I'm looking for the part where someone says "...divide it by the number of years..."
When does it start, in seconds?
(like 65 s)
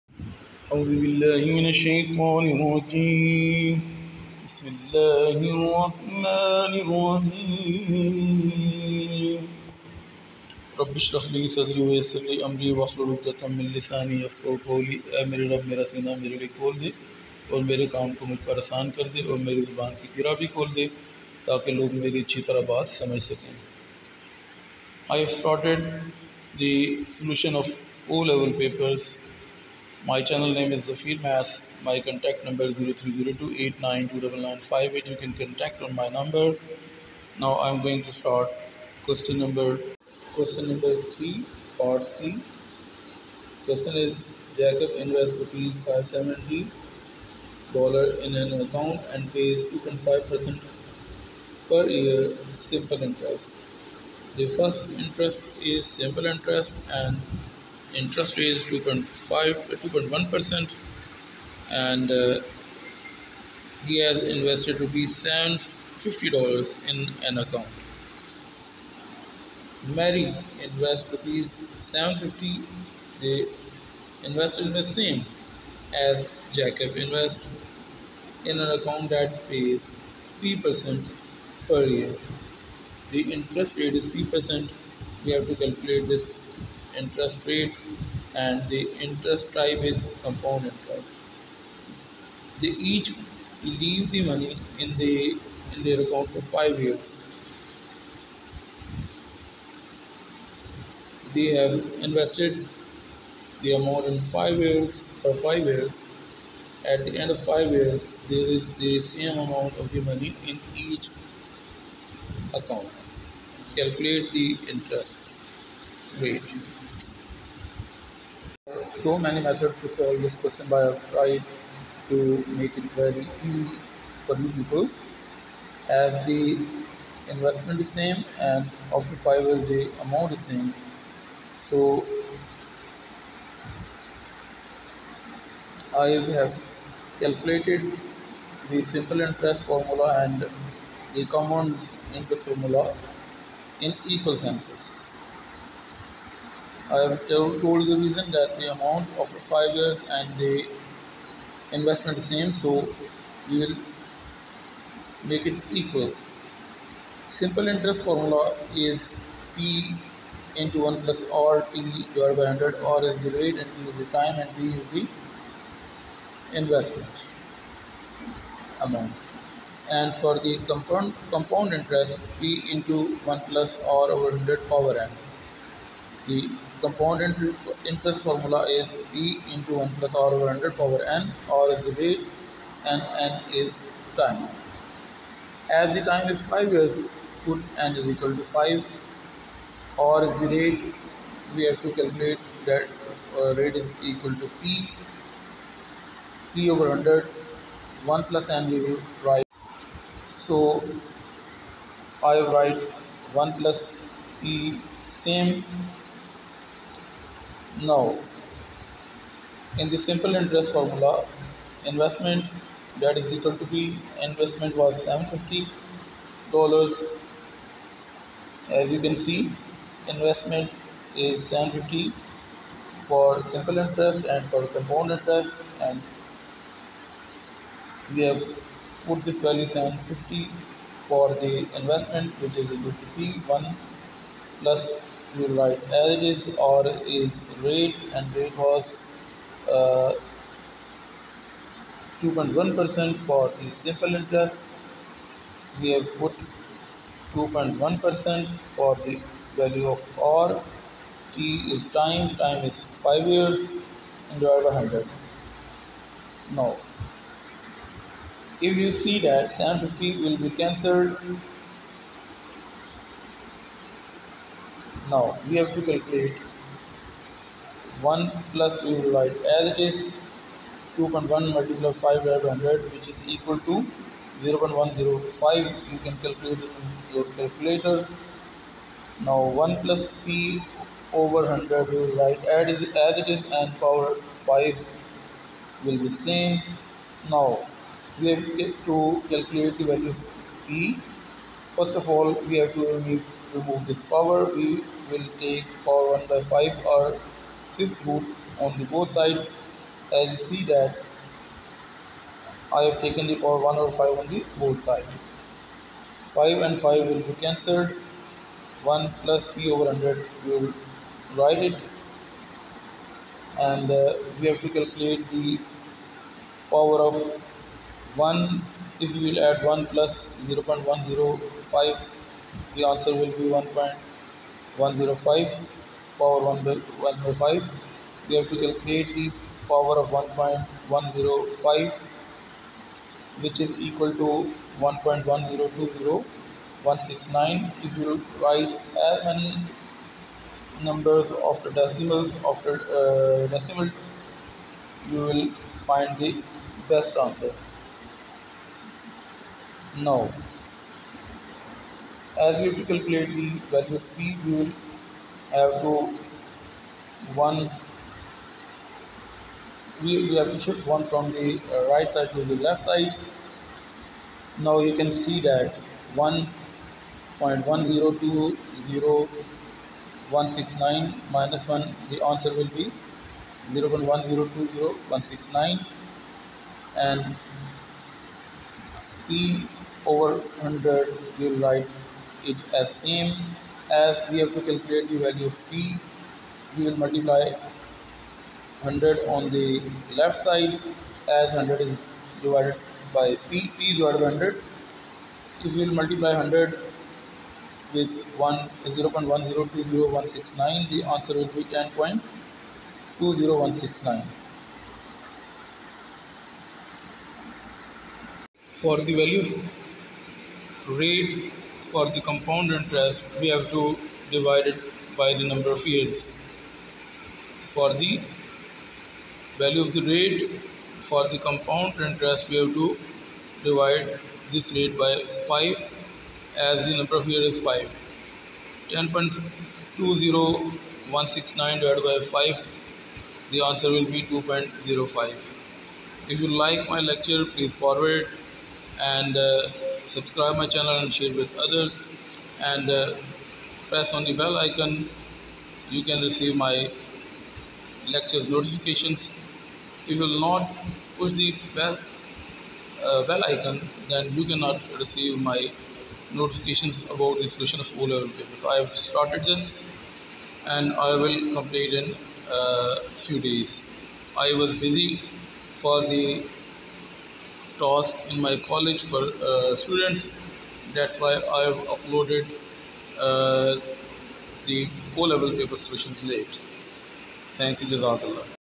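414 s.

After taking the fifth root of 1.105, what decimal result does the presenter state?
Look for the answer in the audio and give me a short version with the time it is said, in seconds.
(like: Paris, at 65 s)
1.1020169, at 334 s.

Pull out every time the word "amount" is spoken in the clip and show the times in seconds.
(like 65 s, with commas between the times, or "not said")
103 s, 109 s, 130 s, 148 s, 168 s.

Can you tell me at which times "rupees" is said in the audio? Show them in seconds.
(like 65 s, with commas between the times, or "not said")
45 s, 64 s, 71 s.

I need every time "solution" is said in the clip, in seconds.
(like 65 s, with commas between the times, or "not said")
457 s, 475 s.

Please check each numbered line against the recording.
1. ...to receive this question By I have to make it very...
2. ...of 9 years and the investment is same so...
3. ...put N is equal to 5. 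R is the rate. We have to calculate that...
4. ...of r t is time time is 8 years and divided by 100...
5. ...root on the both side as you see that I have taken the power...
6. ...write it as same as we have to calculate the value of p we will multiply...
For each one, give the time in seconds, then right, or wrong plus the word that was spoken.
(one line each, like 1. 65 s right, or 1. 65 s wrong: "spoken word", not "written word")
1. 119 s wrong: "solve", not "receive"
2. 149 s wrong: "5", not "9"
3. 187 s right
4. 249 s wrong: "5", not "8"
5. 298 s right
6. 381 s right.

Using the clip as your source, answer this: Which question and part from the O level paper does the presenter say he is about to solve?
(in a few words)
Question 3 part C.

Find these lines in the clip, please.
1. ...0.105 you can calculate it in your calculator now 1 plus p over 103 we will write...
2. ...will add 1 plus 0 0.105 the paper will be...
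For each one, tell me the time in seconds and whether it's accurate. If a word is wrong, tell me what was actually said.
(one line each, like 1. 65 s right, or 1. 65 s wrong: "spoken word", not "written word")
1. 274 s wrong: "100", not "103"
2. 319 s wrong: "answer", not "paper".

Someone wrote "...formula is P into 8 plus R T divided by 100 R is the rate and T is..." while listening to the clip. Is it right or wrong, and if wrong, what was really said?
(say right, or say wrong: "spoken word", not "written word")
wrong: "1", not "8".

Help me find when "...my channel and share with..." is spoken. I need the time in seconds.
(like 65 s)
440 s.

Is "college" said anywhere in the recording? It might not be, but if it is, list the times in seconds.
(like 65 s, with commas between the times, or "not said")
468 s.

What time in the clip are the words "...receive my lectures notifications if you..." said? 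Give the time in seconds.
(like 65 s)
446 s.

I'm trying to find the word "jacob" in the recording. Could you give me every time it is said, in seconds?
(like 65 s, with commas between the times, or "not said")
44 s, 76 s.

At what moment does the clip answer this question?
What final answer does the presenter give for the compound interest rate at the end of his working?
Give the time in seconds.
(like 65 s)
434 s.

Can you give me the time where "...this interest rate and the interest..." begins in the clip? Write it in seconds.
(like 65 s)
86 s.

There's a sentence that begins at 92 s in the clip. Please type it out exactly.
They each leave the money in the in their account for five years.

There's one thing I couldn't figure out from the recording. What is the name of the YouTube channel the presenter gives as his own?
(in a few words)
Zafeer Maths.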